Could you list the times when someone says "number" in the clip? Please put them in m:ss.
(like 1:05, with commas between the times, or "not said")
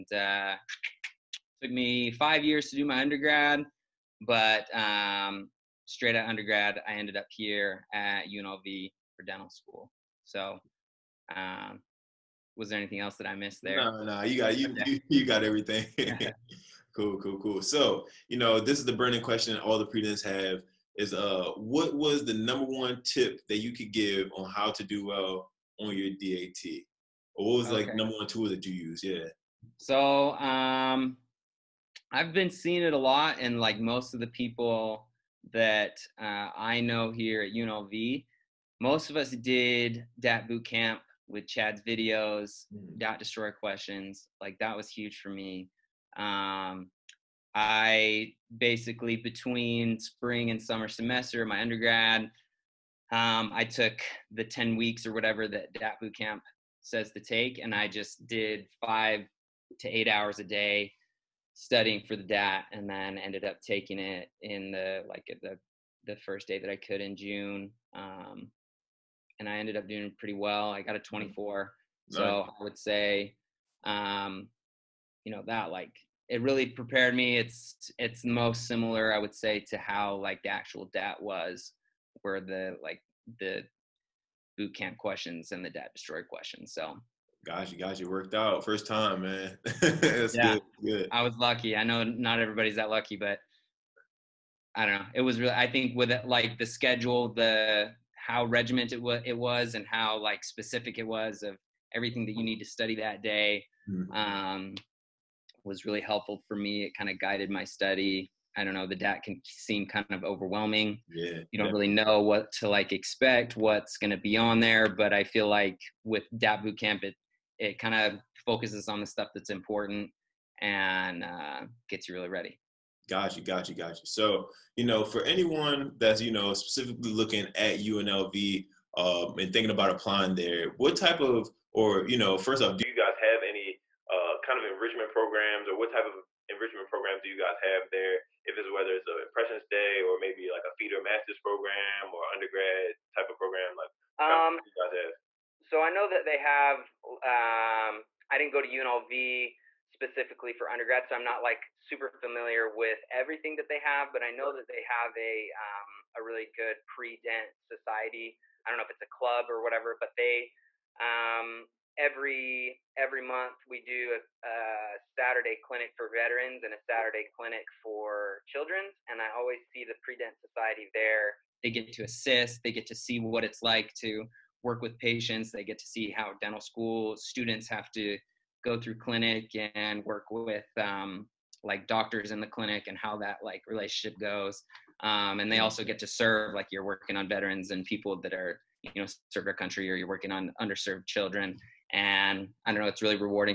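0:22, 0:27.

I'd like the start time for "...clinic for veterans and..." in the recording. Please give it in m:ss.
2:45.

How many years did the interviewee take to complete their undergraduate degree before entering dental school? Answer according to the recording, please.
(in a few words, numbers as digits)
5.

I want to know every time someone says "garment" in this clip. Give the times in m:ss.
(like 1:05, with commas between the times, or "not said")
not said.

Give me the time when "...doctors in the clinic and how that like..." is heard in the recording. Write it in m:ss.
3:01.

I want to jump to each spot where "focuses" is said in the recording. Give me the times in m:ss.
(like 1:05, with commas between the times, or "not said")
1:58.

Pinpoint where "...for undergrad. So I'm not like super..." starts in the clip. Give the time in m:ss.
2:30.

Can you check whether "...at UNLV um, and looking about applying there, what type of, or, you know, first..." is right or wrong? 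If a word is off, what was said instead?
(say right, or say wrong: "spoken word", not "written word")
wrong: "thinking", not "looking".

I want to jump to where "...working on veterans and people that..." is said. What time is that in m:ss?
3:06.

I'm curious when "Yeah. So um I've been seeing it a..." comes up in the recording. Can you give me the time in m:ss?
0:29.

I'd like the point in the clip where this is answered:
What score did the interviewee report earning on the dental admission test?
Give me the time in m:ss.
1:11.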